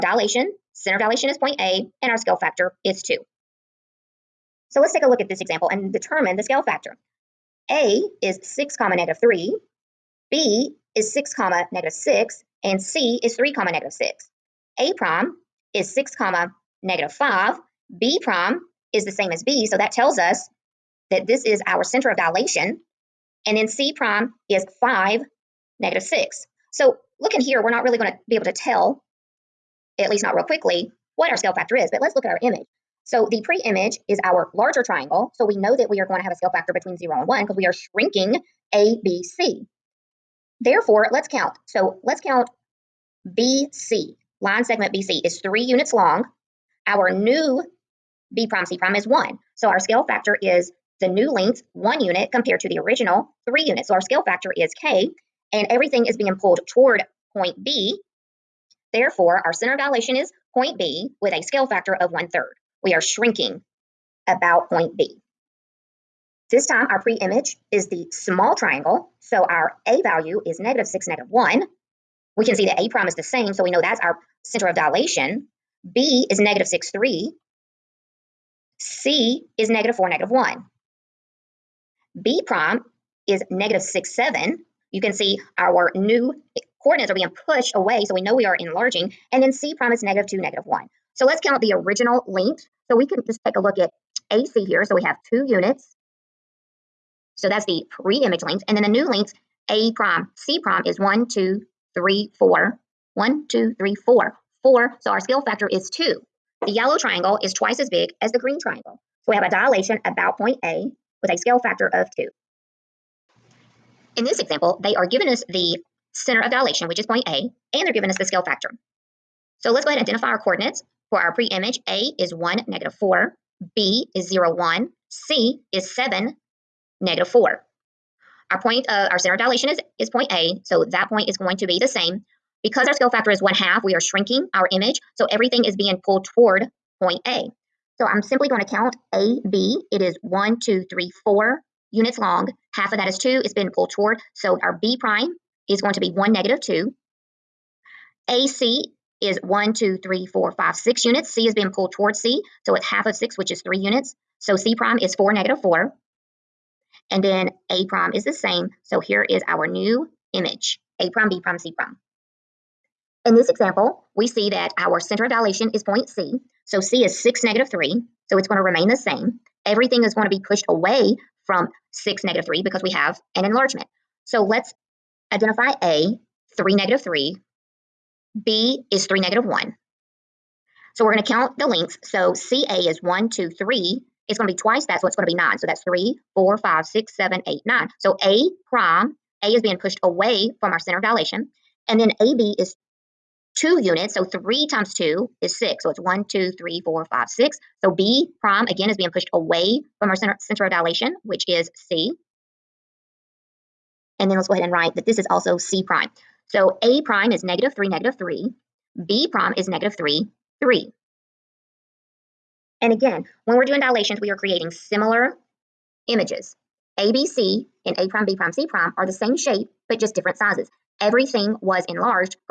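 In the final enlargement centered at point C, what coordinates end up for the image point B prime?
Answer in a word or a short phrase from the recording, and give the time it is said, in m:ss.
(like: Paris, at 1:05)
(-3, 3), at 3:29.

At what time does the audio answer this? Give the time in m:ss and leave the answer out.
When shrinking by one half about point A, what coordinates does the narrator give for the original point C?
2:05.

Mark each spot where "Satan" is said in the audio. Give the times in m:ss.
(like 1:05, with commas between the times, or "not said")
not said.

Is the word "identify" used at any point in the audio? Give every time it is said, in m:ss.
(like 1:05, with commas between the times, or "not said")
2:00, 2:55.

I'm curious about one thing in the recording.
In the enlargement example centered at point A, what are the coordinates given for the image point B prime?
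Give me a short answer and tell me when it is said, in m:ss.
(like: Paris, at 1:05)
(-6, 7), at 1:23.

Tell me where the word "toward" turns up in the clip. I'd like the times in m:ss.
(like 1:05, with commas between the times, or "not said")
0:56, 2:16, 2:23, 2:31.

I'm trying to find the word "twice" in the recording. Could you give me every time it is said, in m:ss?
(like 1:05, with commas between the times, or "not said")
1:47, 3:04.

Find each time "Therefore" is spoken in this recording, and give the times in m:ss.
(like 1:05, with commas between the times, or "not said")
0:40, 0:58.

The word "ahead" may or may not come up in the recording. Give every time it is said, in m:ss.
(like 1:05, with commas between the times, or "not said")
1:59, 3:24.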